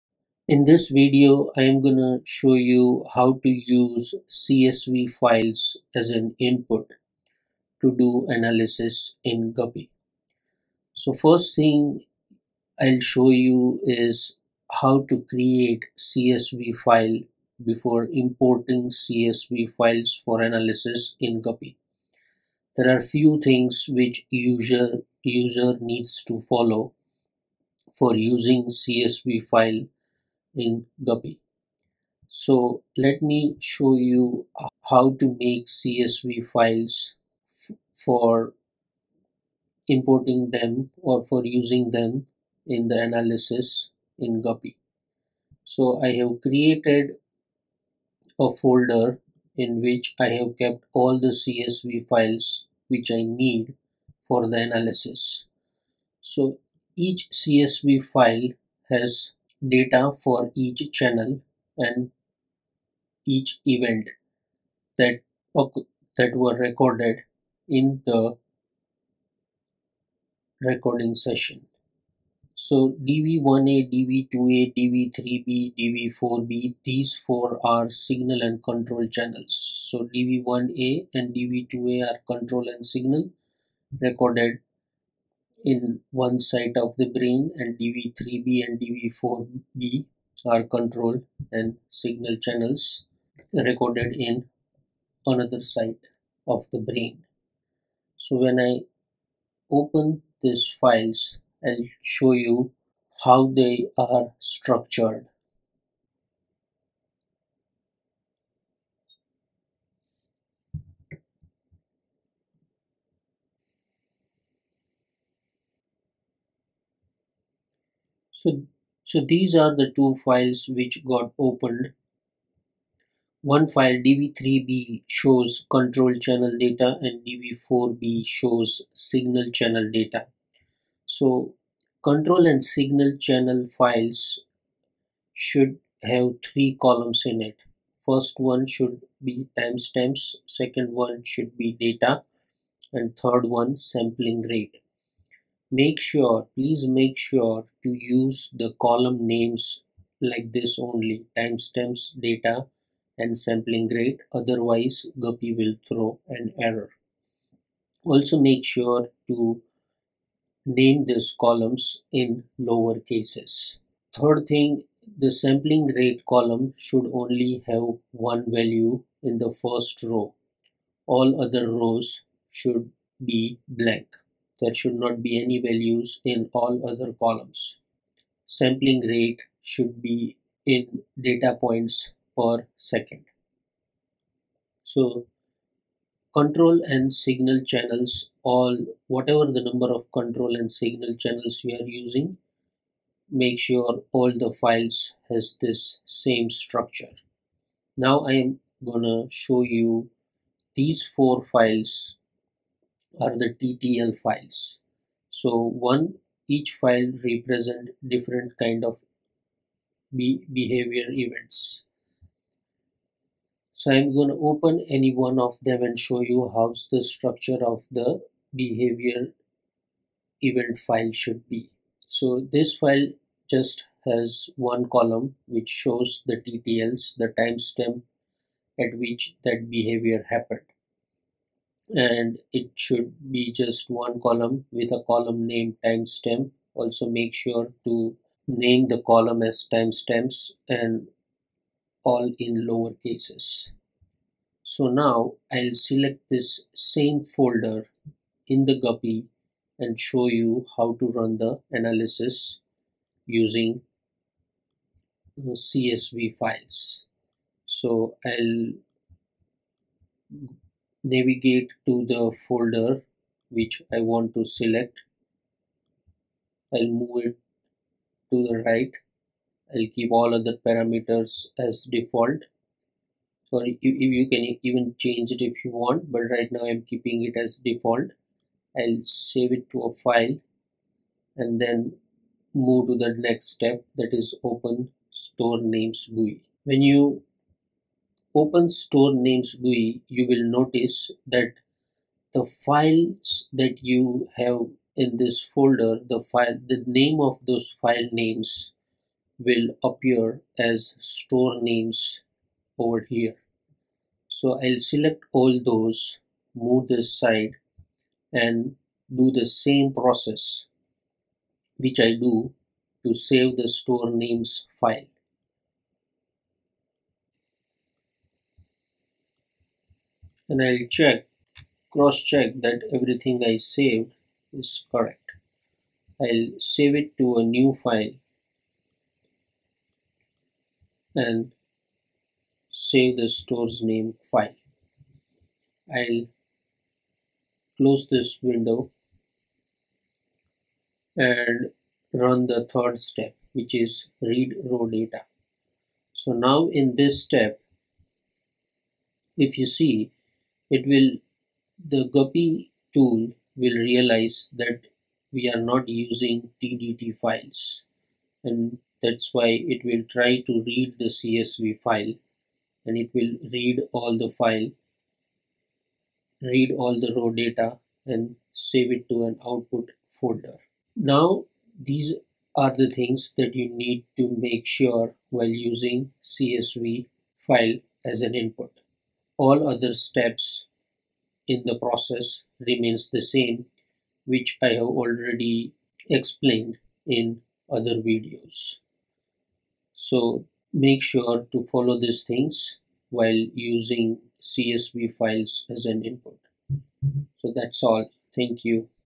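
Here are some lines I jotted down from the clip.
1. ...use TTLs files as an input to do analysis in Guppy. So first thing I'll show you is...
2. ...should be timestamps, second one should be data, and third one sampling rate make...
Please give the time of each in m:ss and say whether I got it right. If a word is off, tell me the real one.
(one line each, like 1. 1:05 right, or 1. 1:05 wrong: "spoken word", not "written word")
1. 0:03 wrong: "CSV", not "TTLs"
2. 2:18 right.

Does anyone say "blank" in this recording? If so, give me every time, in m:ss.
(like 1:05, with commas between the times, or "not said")
2:53.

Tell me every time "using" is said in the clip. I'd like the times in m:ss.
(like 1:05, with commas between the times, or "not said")
0:28, 0:41, 3:11, 4:13, 5:55, 6:15, 6:33.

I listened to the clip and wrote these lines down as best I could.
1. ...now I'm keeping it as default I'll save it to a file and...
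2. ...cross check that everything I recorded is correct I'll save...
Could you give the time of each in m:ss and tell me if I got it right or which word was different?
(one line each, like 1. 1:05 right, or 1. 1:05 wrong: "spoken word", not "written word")
1. 4:36 right
2. 5:21 wrong: "saved", not "recorded".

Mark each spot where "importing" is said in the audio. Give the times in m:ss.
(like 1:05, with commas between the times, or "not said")
0:18, 0:39.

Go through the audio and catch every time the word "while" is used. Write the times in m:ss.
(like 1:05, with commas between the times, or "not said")
6:15, 6:33.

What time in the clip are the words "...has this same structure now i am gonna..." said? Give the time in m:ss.
3:15.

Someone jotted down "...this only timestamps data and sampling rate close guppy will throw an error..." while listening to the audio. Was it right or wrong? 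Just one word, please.
wrong.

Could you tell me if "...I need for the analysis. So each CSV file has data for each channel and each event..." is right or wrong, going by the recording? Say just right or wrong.
right.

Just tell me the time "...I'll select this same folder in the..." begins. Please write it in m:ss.
4:05.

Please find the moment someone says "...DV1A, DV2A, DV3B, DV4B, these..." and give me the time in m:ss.
1:13.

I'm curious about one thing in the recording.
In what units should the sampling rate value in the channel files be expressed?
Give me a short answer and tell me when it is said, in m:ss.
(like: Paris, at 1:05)
Data points per second, at 3:01.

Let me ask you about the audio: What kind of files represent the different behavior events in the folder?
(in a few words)
TTL files.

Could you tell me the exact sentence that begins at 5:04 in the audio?
So I'll select all those, move this side and do the same process which I do to save the store names file.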